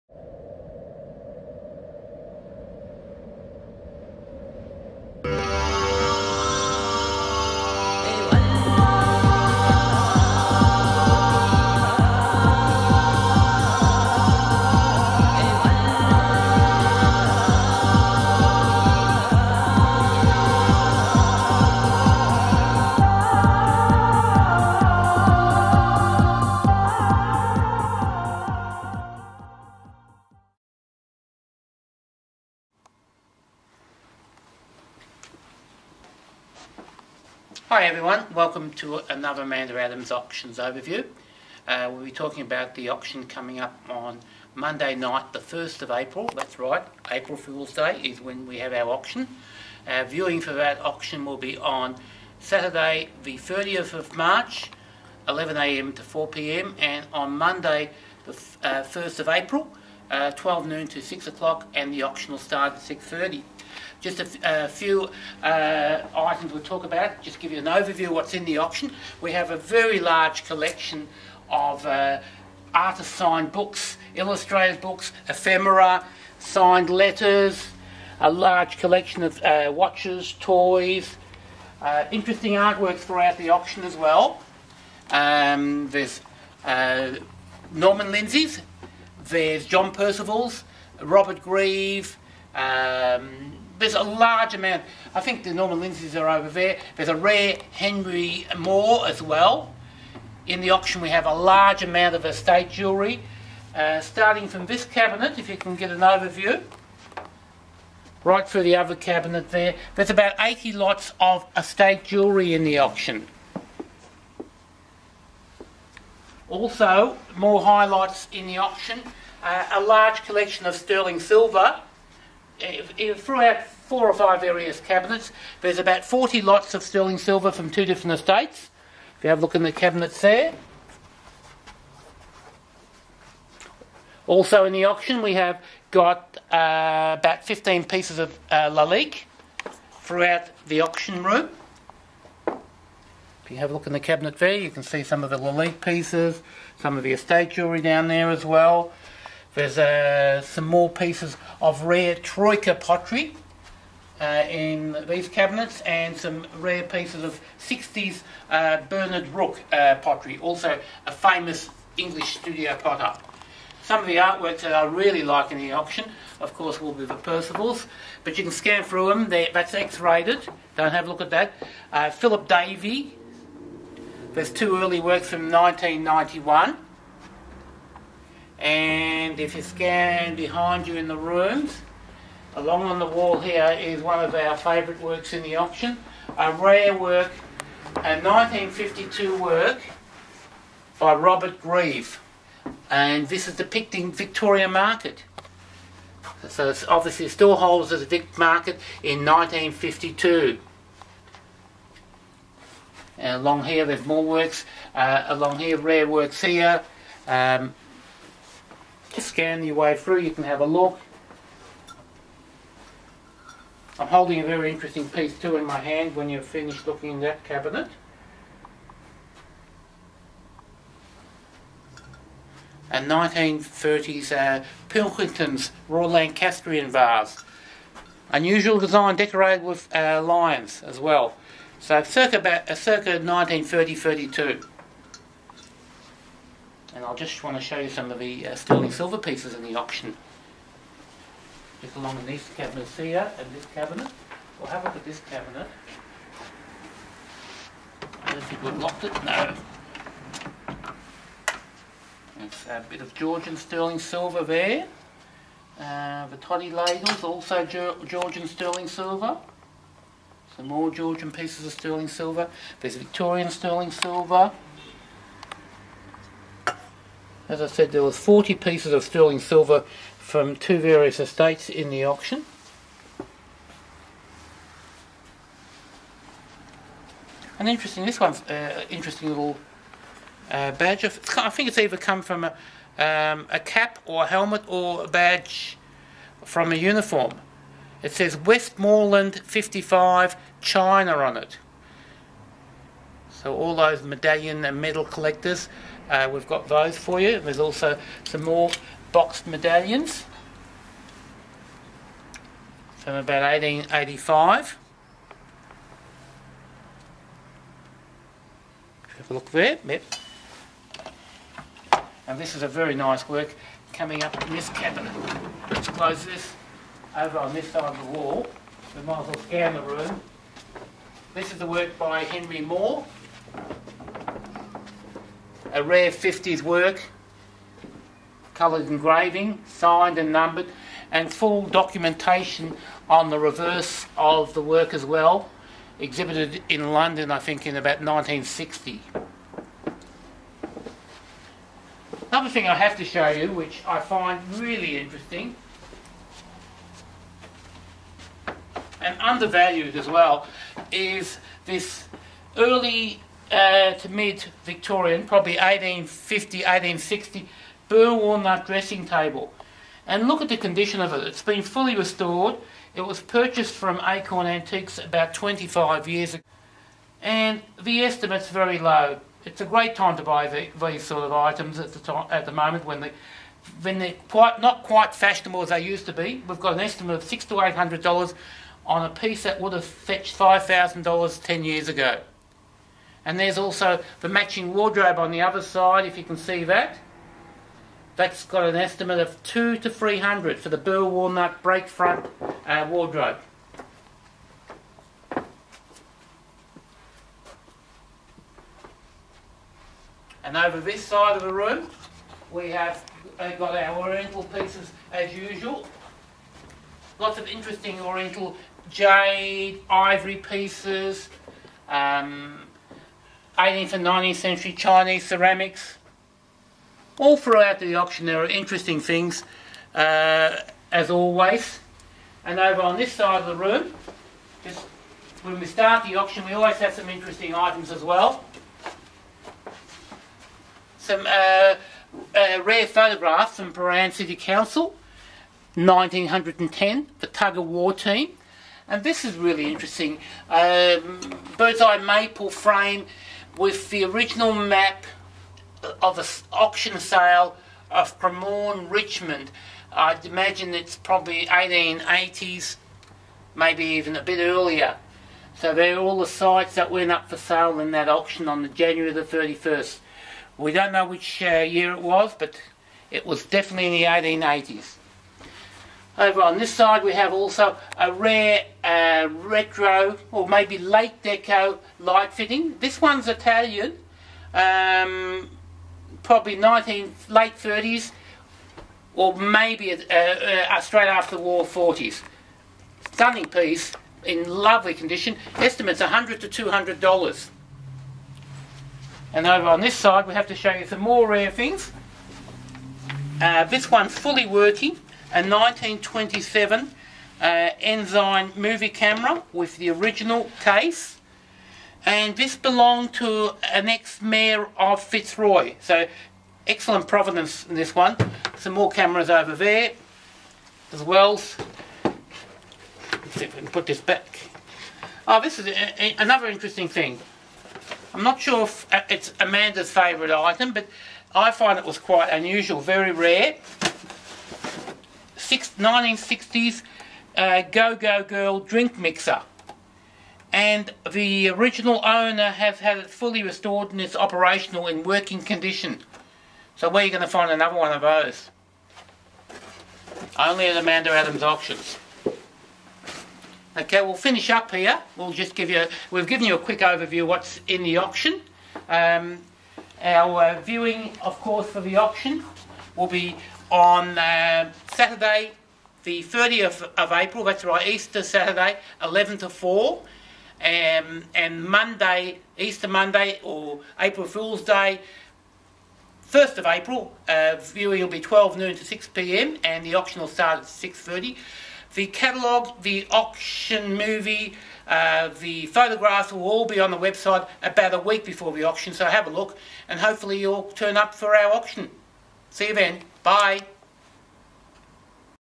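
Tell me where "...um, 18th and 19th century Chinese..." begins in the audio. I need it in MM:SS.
06:51.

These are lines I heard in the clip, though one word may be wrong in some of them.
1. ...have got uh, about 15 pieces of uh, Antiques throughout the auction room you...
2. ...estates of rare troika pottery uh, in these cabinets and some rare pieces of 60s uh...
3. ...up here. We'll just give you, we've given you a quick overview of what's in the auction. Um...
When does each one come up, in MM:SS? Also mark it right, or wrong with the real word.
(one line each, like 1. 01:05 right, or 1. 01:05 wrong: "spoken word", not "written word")
1. 02:15 wrong: "Lalique", not "Antiques"
2. 02:30 wrong: "pieces", not "estates"
3. 09:04 right.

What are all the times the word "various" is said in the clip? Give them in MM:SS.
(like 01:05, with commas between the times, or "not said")
02:04, 04:30.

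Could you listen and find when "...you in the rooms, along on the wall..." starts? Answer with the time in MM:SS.
03:00.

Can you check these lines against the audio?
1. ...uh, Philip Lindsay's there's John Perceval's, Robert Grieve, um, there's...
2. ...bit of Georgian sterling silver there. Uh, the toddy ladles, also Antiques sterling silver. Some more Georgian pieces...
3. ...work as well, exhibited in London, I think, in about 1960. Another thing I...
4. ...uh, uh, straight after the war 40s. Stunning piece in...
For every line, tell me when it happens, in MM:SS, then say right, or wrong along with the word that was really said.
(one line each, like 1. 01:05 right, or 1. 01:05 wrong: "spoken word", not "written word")
1. 01:26 wrong: "Norman", not "Philip"
2. 04:12 wrong: "Georgian", not "Antiques"
3. 05:34 right
4. 07:59 right.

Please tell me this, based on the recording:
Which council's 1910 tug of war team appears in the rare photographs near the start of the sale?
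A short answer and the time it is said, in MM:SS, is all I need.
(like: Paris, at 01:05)
Prahran City Council, at 07:13.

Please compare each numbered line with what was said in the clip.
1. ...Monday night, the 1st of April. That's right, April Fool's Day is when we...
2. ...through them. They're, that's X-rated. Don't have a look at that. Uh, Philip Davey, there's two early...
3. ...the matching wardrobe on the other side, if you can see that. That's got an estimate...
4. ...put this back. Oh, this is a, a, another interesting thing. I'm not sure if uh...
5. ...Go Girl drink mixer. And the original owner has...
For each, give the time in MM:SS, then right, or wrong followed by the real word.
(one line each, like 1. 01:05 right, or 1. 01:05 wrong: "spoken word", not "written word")
1. 00:44 right
2. 02:48 right
3. 06:24 right
4. 08:33 right
5. 08:47 right.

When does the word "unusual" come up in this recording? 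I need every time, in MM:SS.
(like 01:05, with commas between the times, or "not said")
03:48, 08:42.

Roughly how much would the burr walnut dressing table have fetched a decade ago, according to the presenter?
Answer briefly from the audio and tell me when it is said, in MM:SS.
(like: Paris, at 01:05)
$5,000, at 06:20.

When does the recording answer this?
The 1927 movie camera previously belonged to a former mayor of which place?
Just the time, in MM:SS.
08:25.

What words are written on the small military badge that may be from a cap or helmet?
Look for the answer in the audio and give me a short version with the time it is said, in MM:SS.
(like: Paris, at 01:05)
Westmoreland 55 China, at 04:48.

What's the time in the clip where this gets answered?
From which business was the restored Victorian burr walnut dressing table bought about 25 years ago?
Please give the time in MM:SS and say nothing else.
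06:04.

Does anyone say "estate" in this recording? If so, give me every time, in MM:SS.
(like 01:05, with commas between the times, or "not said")
01:42, 01:51, 02:08, 02:27, 04:31.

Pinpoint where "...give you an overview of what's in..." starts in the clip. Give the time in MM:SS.
01:07.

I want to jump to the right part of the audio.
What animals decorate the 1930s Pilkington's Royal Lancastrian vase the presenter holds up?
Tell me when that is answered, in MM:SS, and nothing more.
03:50.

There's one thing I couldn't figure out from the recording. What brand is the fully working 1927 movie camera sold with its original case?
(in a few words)
Ensign.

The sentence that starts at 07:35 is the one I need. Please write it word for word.
So they're all the sites that went up for sale in that auction on the January the 31st.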